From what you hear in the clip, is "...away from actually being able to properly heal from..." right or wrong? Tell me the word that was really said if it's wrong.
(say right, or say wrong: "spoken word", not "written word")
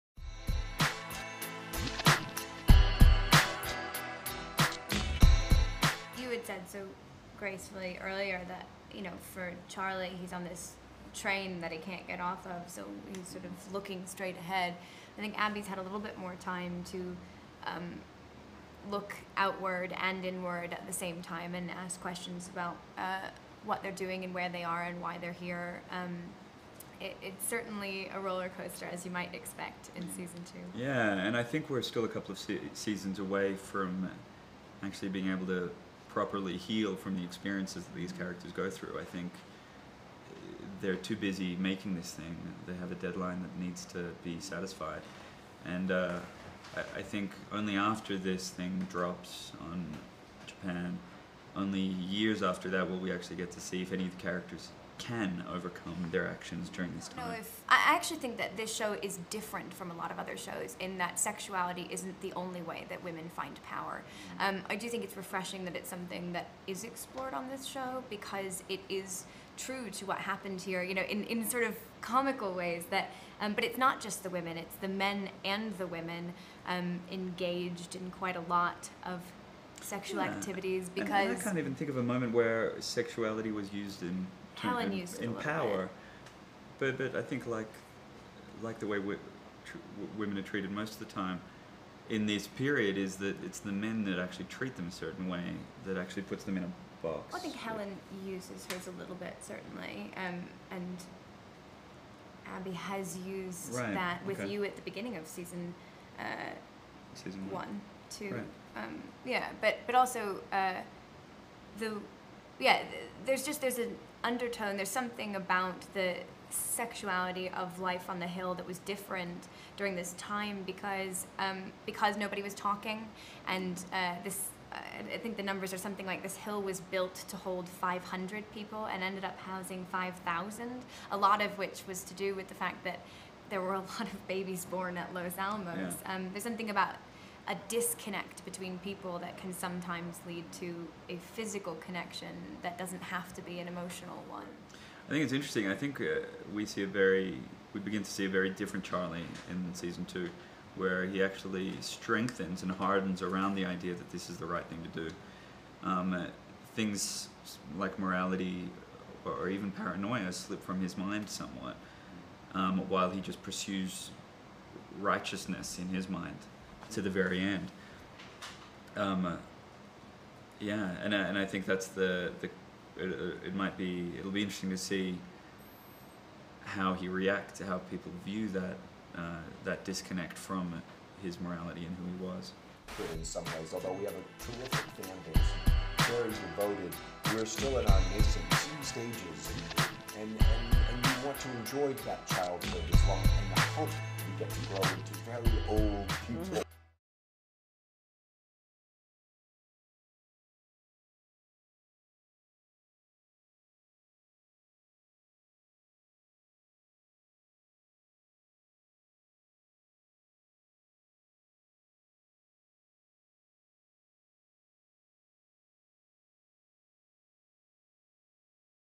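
right.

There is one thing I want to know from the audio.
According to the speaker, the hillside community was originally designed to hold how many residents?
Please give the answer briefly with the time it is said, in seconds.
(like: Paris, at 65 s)
500, at 127 s.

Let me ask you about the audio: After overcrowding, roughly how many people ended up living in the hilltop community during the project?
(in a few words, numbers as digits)
5,000.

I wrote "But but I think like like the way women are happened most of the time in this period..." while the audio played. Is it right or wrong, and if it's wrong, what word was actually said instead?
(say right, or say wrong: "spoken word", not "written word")
wrong: "treated", not "happened".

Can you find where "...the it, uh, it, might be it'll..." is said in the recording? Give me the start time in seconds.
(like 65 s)
172 s.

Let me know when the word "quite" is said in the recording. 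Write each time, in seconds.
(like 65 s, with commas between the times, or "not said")
78 s.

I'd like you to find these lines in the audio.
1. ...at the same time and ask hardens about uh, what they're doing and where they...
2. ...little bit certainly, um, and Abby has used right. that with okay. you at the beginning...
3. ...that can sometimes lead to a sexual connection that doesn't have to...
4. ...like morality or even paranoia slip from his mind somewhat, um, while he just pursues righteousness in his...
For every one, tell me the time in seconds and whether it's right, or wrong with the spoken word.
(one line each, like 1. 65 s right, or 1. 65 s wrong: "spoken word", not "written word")
1. 20 s wrong: "questions", not "hardens"
2. 98 s right
3. 139 s wrong: "physical", not "sexual"
4. 157 s right.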